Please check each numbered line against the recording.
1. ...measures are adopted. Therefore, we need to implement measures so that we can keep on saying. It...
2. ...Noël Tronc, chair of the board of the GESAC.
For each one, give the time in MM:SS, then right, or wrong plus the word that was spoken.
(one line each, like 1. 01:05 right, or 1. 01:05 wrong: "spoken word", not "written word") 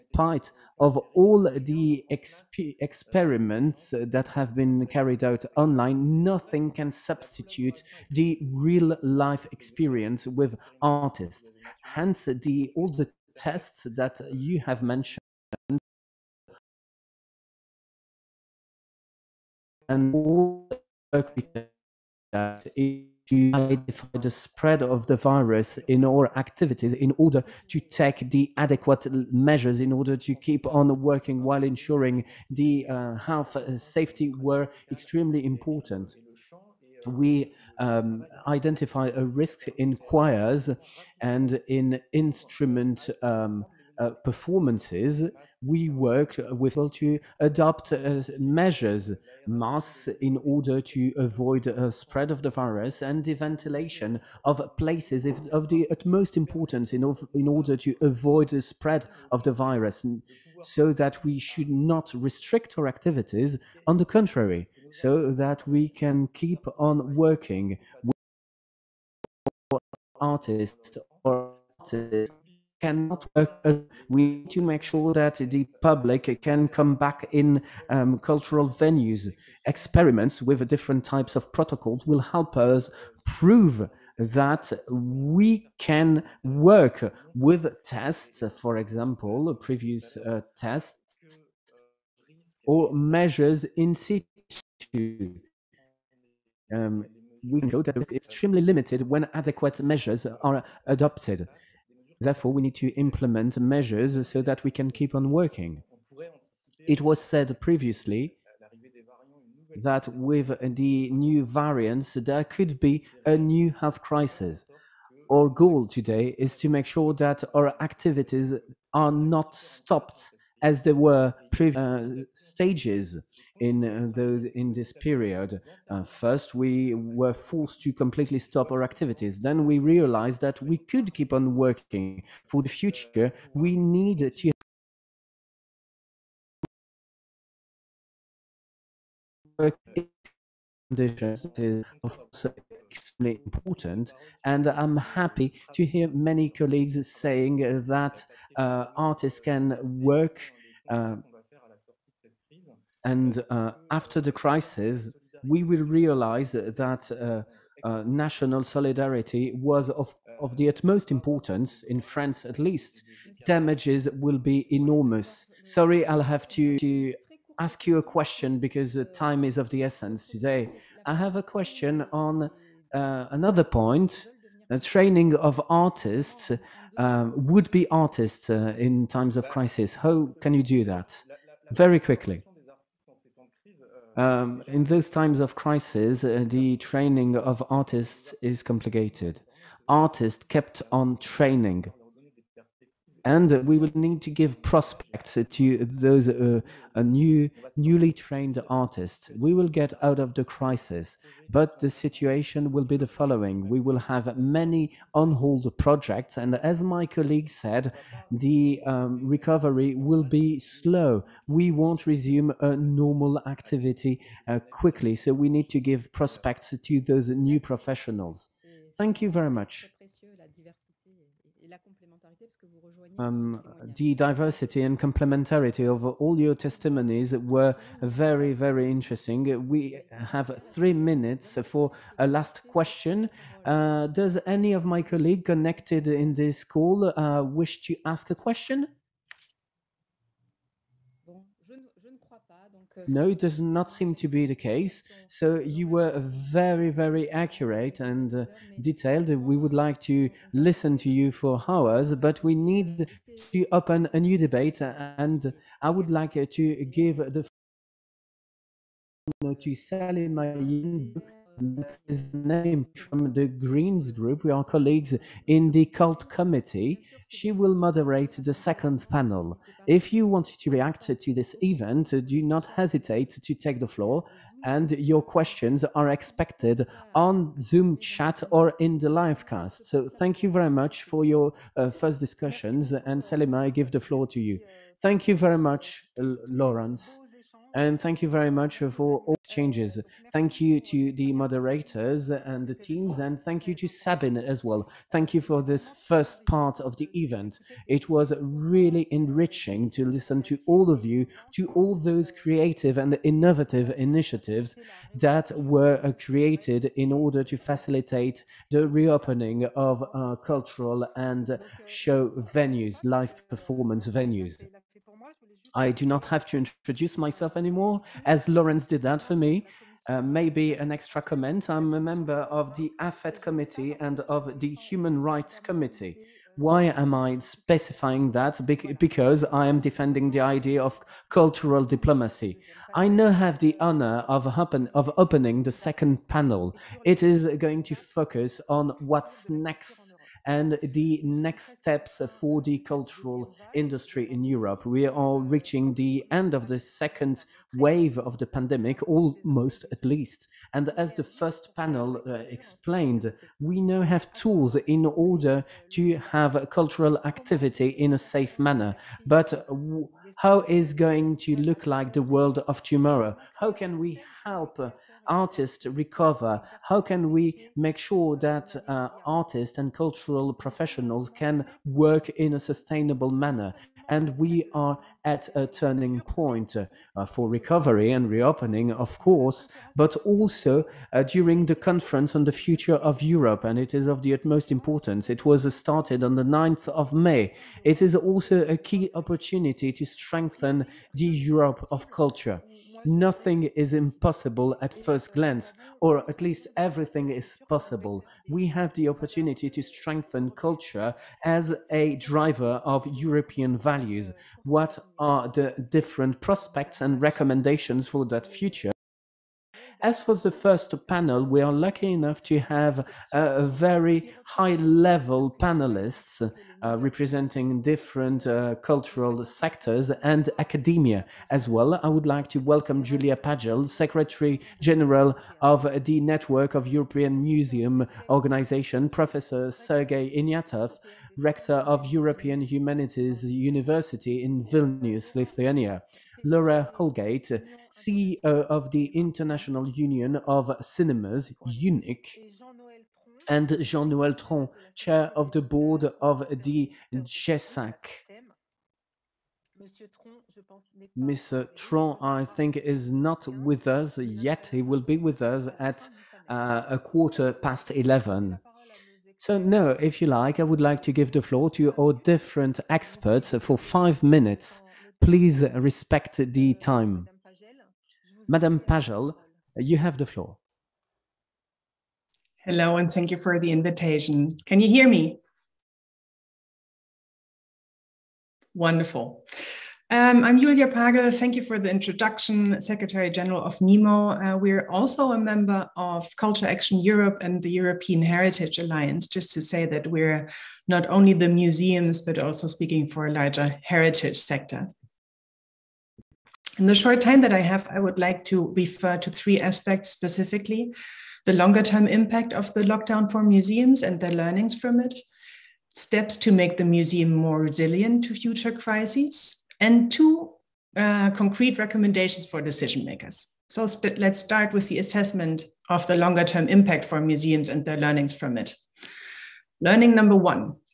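1. 01:39 wrong: "working", not "saying"
2. 07:24 right.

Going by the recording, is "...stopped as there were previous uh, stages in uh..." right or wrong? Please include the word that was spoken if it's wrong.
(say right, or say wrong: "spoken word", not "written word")
right.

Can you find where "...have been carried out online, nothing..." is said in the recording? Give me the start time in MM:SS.
00:04.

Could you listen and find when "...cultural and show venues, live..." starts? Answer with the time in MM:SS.
05:10.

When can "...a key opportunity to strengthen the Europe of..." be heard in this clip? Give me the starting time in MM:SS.
06:28.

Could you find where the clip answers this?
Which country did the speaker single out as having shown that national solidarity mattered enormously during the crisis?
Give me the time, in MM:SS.
02:41.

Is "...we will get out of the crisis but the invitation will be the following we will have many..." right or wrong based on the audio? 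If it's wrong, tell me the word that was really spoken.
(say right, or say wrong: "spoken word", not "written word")
wrong: "situation", not "invitation".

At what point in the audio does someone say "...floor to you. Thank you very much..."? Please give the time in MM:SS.
04:43.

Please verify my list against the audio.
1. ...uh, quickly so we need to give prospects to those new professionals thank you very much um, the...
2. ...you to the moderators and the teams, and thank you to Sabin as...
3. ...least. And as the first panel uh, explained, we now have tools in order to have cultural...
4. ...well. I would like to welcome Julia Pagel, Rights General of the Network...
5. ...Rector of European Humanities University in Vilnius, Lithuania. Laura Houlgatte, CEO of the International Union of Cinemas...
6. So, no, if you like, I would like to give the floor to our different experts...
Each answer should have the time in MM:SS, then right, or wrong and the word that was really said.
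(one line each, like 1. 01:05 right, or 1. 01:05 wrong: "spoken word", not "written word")
1. 03:34 right
2. 04:50 right
3. 05:50 right
4. 07:01 wrong: "Secretary", not "Rights"
5. 07:11 right
6. 07:39 right.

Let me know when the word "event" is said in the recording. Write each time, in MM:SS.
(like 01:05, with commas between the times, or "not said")
04:31, 04:57.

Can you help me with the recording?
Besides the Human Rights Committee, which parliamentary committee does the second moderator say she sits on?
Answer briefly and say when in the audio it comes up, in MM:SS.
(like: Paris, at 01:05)
AFET, at 05:22.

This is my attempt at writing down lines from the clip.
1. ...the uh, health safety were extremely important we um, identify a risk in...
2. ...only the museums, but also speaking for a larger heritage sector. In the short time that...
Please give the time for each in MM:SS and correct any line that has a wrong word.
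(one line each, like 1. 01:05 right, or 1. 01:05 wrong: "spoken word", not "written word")
1. 00:32 right
2. 08:11 right.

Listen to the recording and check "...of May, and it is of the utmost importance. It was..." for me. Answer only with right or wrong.
wrong.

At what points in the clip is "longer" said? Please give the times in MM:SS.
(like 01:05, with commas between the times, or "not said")
08:21, 08:36.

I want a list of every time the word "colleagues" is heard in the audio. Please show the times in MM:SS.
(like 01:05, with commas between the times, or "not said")
02:26, 03:27, 03:55, 04:24.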